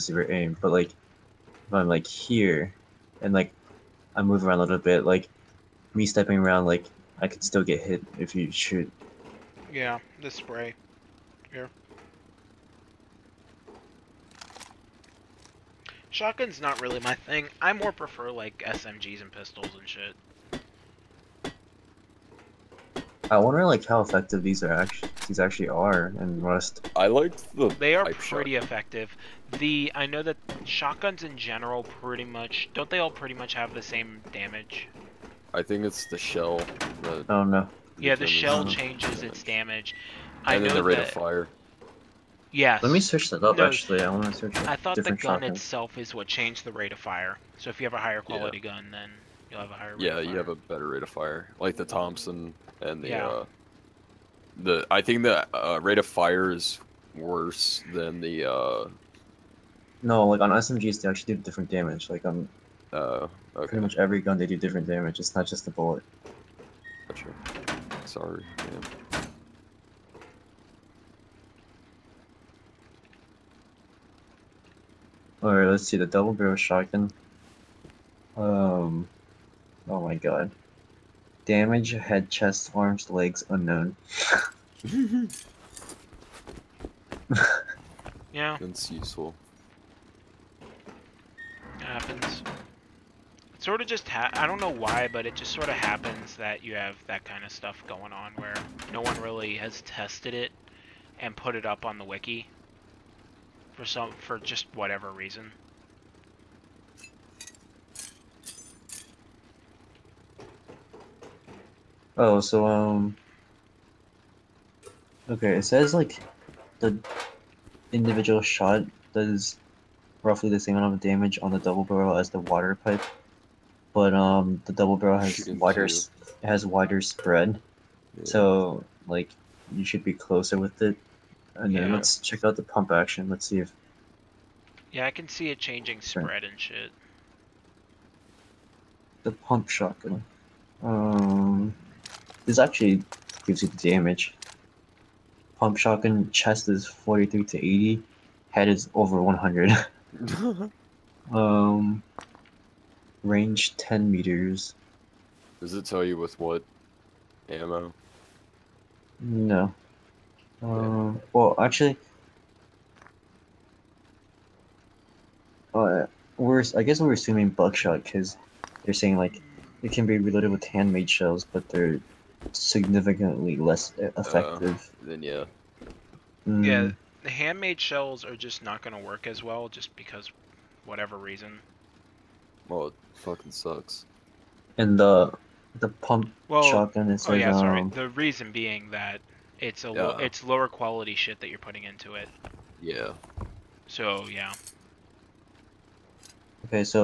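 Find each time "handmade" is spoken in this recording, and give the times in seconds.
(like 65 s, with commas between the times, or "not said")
170 s, 177 s.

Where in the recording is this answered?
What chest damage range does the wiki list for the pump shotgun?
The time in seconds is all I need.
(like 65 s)
146 s.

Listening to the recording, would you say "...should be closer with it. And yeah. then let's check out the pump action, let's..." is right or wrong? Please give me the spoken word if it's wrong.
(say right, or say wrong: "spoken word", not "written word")
right.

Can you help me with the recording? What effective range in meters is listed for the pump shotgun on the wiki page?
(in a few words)
10 meters.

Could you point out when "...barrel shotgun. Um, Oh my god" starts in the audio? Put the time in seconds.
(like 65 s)
76 s.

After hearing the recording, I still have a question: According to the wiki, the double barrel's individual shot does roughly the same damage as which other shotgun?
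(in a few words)
water pipe.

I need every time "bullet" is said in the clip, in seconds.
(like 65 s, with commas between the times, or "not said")
65 s.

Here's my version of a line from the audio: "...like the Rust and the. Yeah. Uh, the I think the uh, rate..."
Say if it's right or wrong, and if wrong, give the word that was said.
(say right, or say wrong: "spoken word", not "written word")
wrong: "Thompson", not "Rust".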